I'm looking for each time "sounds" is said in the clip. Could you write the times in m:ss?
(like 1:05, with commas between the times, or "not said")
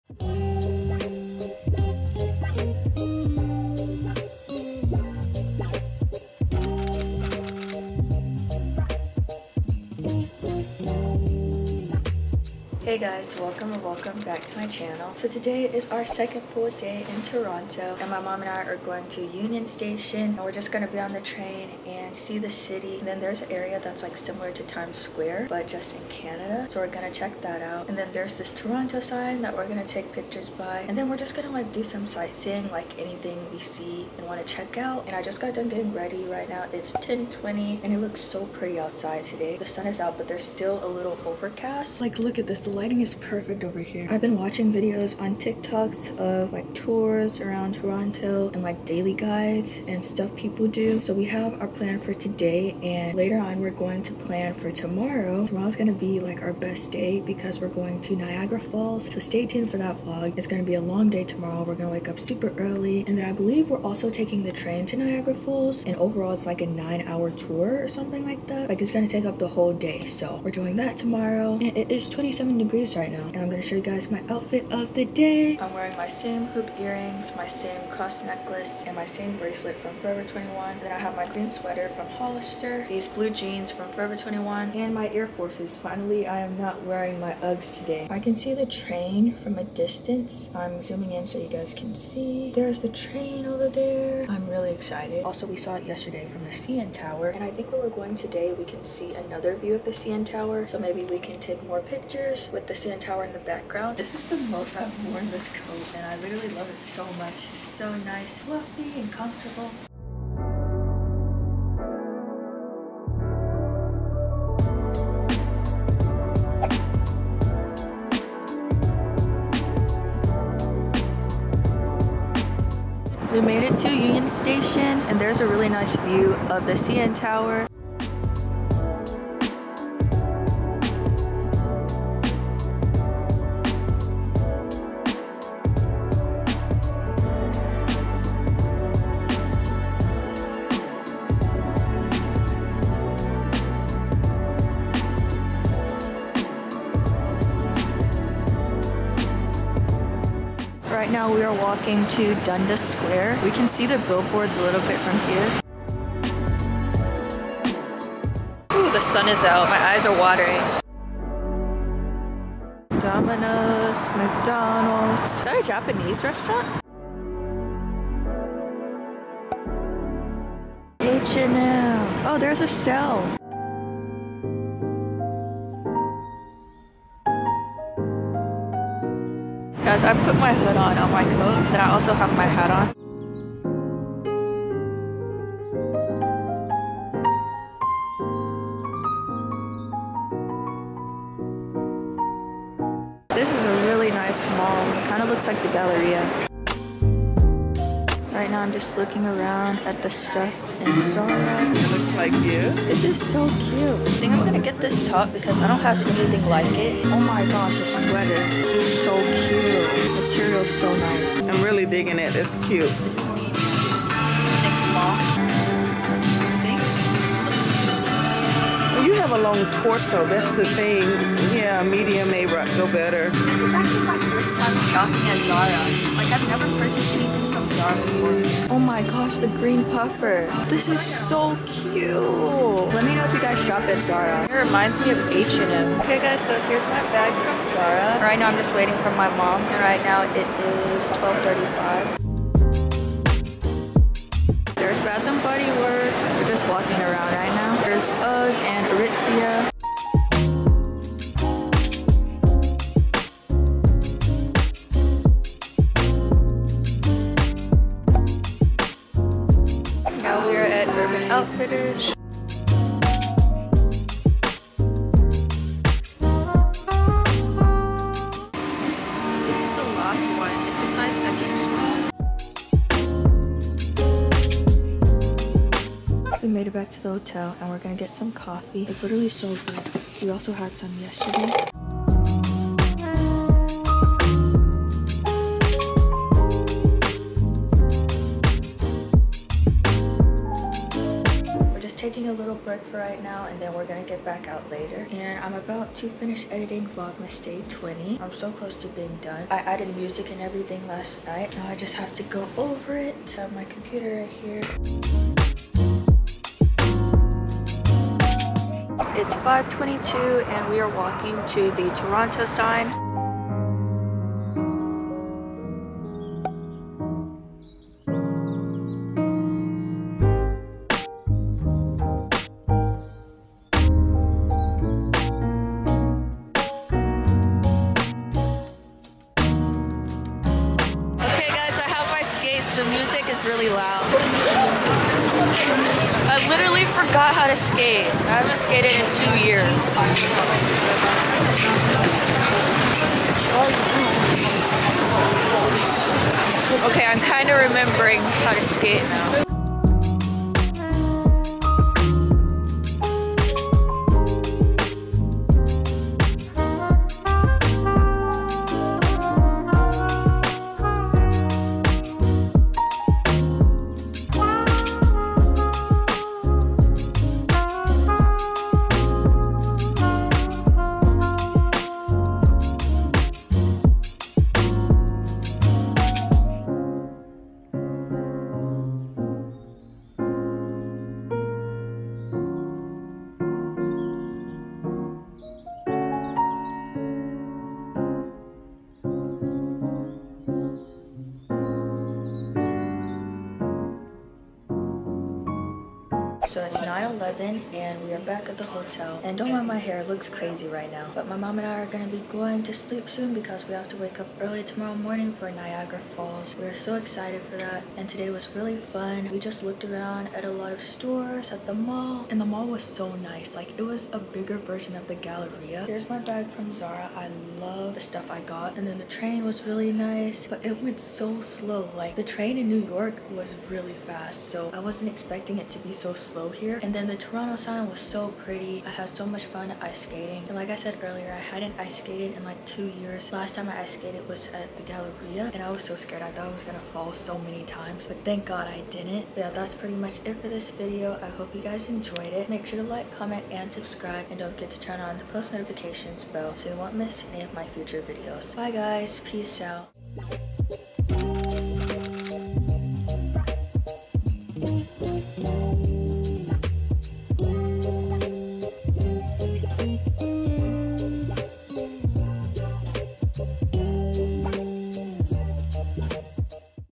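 not said.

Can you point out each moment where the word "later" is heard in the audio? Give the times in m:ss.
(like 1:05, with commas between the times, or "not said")
0:53, 4:54.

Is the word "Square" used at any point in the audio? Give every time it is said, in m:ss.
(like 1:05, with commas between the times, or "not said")
0:24, 2:32.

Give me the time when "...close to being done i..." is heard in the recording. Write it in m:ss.
4:58.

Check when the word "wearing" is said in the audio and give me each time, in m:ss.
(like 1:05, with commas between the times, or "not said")
1:15, 1:26.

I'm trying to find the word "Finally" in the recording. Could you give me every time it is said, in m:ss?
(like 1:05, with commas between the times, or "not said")
1:25.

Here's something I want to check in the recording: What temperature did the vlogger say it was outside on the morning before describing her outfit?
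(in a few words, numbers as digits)
27 degrees.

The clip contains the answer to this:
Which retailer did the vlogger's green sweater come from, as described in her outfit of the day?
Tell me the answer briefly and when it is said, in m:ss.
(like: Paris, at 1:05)
Hollister, at 1:22.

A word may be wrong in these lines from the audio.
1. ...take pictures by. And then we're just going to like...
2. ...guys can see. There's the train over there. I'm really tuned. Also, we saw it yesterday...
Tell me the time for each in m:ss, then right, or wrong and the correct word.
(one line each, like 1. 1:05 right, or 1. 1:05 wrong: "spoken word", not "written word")
1. 0:29 right
2. 1:31 wrong: "excited", not "tuned".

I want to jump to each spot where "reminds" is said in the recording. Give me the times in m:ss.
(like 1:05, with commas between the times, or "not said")
3:54.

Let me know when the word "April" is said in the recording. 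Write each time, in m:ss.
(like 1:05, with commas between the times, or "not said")
not said.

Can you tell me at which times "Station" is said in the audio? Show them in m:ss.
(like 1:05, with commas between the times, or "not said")
0:19, 2:04.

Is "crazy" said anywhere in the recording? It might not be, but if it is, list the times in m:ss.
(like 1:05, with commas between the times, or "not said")
6:40.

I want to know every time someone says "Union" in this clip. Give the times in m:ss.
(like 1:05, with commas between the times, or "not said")
0:19, 2:03.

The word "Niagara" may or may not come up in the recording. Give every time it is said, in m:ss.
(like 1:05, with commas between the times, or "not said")
0:58, 1:04, 6:45.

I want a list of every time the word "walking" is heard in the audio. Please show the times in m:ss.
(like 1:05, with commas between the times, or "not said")
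2:31, 4:06, 5:10.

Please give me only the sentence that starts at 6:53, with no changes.
Like it was a bigger version of the Galleria.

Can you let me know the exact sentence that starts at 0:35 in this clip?
And I just got done getting ready right now.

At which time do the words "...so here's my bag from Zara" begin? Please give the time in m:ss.
3:56.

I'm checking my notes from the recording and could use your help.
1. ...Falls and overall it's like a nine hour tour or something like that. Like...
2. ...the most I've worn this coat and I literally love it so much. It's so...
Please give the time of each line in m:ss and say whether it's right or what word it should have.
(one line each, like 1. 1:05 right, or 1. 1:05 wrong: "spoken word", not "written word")
1. 1:05 right
2. 1:44 right.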